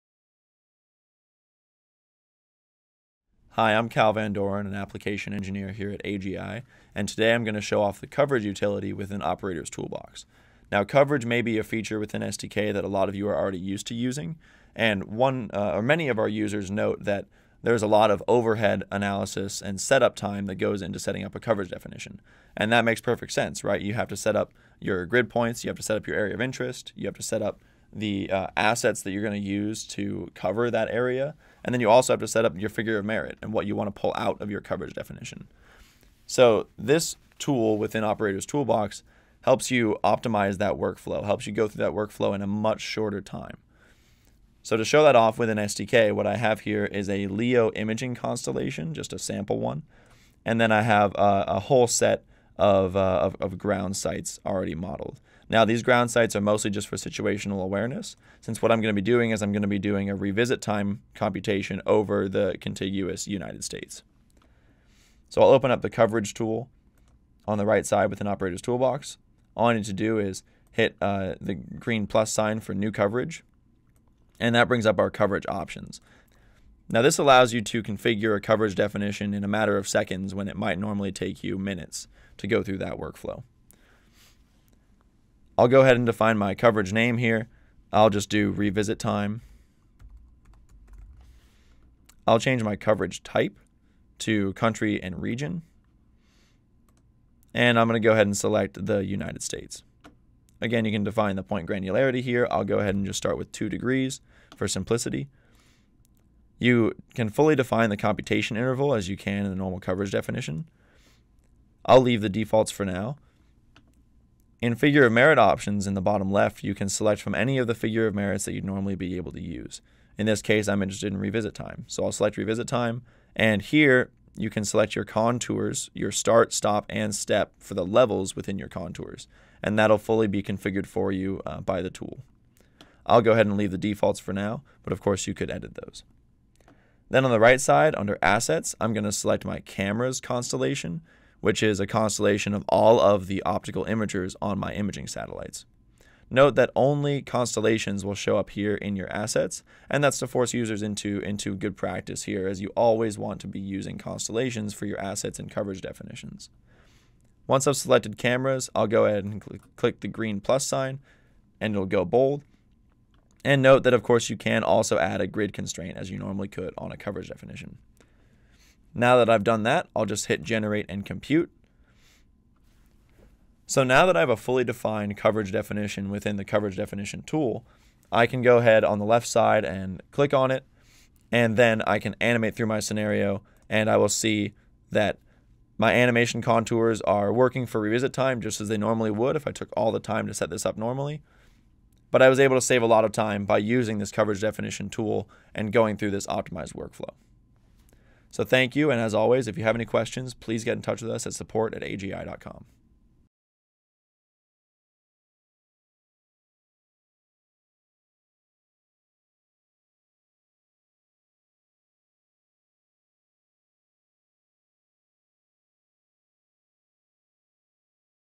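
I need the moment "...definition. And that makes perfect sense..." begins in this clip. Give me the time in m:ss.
0:21.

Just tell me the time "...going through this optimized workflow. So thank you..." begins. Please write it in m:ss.
3:15.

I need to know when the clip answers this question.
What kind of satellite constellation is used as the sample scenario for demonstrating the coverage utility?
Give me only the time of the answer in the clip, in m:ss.
0:47.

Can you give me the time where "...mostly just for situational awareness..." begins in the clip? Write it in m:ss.
0:56.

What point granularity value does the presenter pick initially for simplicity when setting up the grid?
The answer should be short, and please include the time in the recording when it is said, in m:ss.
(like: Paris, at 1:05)
2 degrees, at 1:43.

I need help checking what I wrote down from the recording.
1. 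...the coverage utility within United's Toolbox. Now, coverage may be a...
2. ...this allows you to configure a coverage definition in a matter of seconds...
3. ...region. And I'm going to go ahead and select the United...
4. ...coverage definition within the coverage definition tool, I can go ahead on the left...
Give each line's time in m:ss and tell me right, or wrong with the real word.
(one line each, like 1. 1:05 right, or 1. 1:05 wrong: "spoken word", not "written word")
1. 0:07 wrong: "Operator", not "United"
2. 1:17 right
3. 1:35 right
4. 2:55 right.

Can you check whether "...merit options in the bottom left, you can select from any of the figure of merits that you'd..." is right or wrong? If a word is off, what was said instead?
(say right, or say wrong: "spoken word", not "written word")
right.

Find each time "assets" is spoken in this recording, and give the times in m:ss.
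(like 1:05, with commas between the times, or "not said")
0:28, 2:18, 2:29, 2:35.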